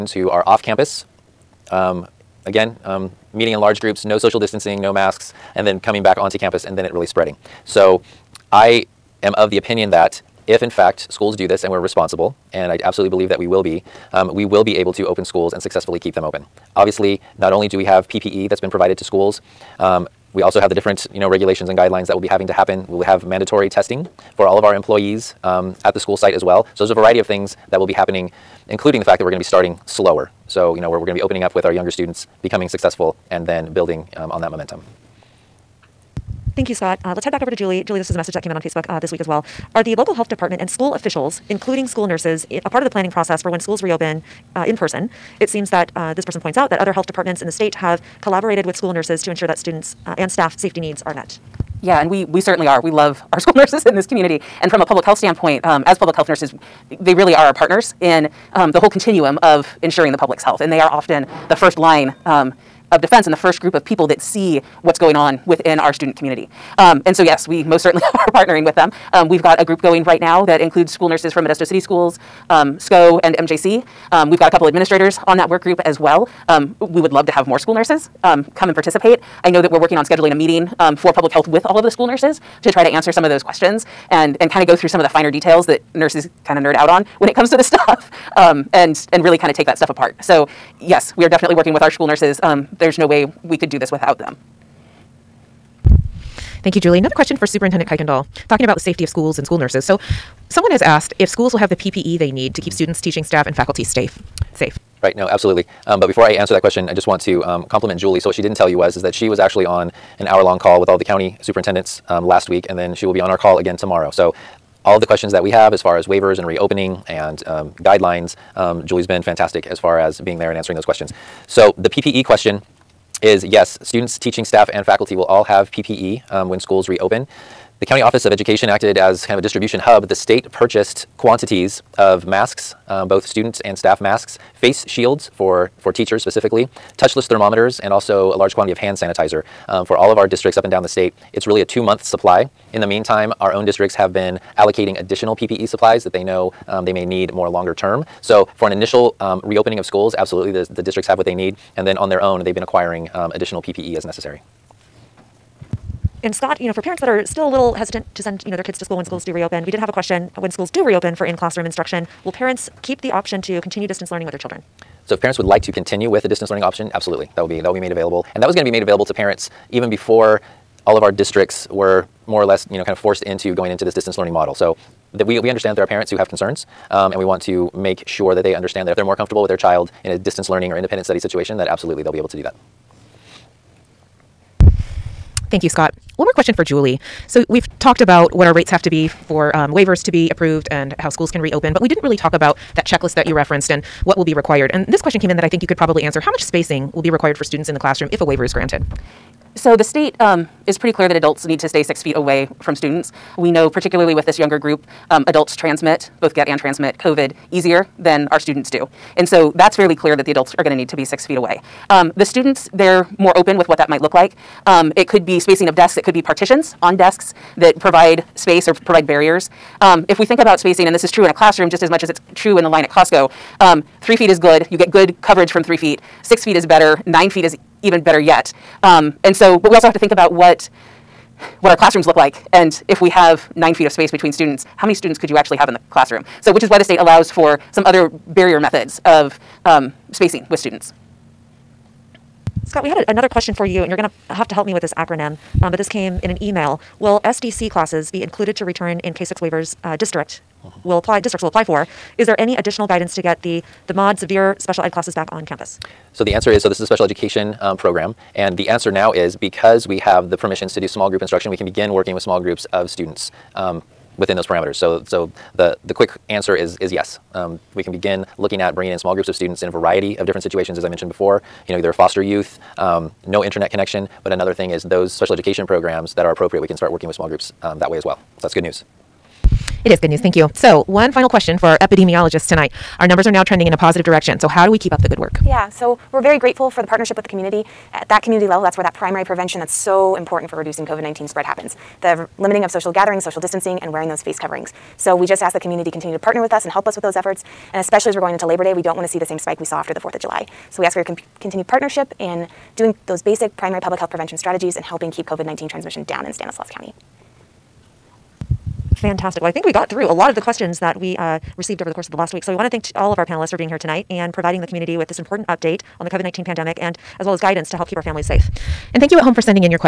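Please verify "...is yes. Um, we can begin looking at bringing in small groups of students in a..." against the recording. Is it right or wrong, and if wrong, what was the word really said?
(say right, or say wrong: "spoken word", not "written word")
right.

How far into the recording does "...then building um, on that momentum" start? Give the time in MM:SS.
00:33.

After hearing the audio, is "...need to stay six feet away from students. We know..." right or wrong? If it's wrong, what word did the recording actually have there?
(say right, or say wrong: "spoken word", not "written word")
right.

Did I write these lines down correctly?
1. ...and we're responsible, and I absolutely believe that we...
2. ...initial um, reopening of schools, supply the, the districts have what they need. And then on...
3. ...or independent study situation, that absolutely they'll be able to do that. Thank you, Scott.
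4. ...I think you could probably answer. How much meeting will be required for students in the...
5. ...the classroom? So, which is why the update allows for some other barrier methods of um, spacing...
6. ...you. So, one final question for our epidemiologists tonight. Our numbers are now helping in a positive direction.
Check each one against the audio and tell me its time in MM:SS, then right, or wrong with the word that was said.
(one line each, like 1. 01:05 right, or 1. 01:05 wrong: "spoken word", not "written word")
1. 00:11 right
2. 02:28 wrong: "absolutely", not "supply"
3. 03:00 right
4. 03:15 wrong: "spacing", not "meeting"
5. 03:55 wrong: "state", not "update"
6. 04:40 wrong: "trending", not "helping".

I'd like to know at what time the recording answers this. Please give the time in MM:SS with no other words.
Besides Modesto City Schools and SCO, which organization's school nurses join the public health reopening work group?
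01:13.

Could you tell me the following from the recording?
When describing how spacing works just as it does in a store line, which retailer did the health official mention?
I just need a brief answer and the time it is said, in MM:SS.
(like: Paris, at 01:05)
Costco, at 03:42.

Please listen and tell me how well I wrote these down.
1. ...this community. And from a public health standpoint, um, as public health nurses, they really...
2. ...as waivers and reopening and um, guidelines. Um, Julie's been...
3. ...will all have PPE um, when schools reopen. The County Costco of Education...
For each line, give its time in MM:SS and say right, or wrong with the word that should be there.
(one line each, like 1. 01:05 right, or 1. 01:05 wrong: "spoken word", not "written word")
1. 00:53 right
2. 01:55 right
3. 02:05 wrong: "Office", not "Costco".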